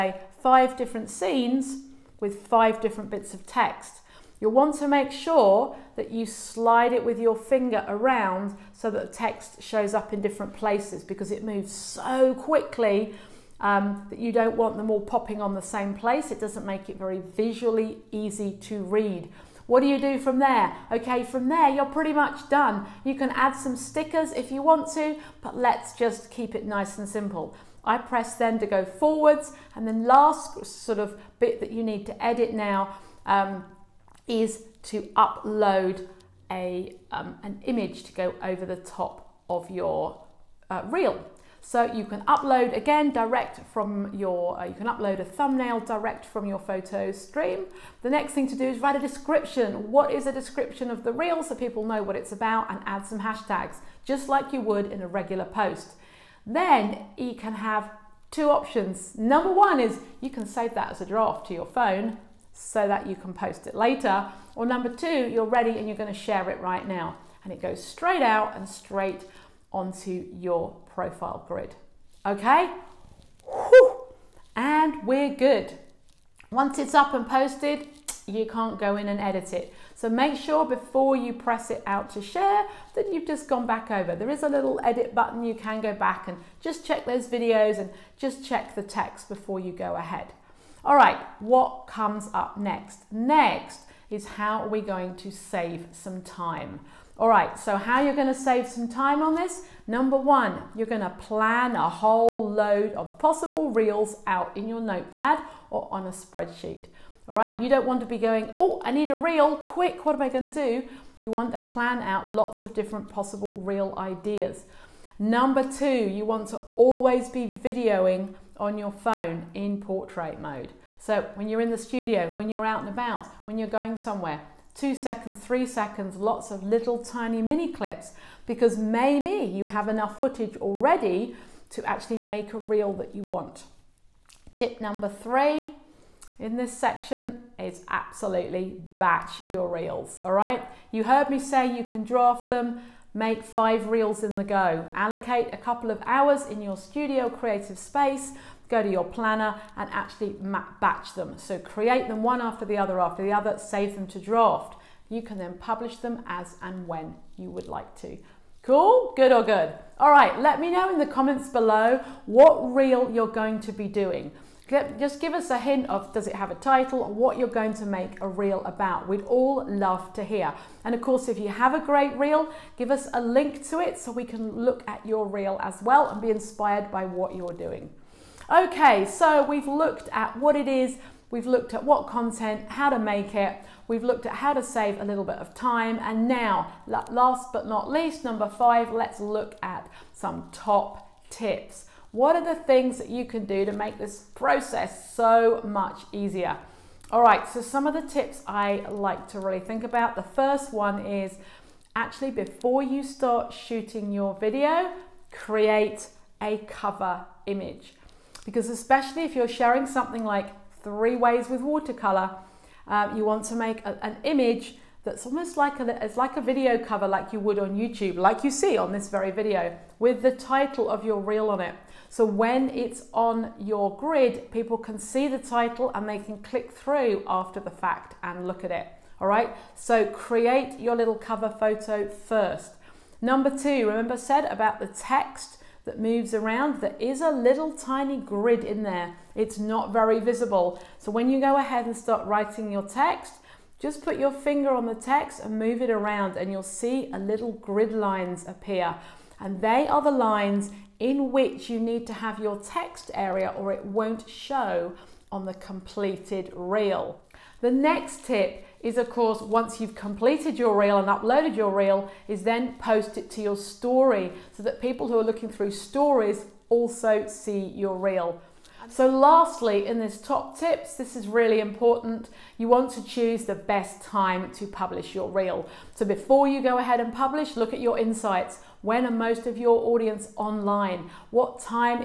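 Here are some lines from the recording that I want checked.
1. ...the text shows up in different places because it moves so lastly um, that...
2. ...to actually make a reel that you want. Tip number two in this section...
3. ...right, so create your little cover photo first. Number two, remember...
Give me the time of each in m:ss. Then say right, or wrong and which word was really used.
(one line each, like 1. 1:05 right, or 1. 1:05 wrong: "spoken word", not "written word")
1. 0:09 wrong: "quickly", not "lastly"
2. 2:11 wrong: "three", not "two"
3. 3:49 right.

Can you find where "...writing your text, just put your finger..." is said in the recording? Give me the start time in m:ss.
4:02.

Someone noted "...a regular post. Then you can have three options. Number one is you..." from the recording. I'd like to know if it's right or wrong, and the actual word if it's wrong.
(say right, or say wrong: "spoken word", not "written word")
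wrong: "two", not "three".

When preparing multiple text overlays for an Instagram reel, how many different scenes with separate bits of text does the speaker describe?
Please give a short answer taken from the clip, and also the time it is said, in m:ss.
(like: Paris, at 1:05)
5, at 0:00.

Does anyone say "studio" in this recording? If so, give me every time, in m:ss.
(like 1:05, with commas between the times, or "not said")
2:01, 2:26.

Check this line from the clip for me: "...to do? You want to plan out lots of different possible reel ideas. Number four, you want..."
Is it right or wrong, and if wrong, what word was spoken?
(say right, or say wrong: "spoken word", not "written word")
wrong: "two", not "four".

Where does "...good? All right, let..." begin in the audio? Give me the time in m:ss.
2:39.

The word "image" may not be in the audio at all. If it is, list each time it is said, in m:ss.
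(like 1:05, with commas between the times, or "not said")
0:37, 3:27, 3:34.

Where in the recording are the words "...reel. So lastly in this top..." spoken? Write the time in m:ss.
4:27.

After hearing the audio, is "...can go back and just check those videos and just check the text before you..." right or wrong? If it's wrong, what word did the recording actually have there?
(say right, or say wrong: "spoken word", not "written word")
right.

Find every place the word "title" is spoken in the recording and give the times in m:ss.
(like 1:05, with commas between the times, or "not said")
2:46, 3:40, 3:45.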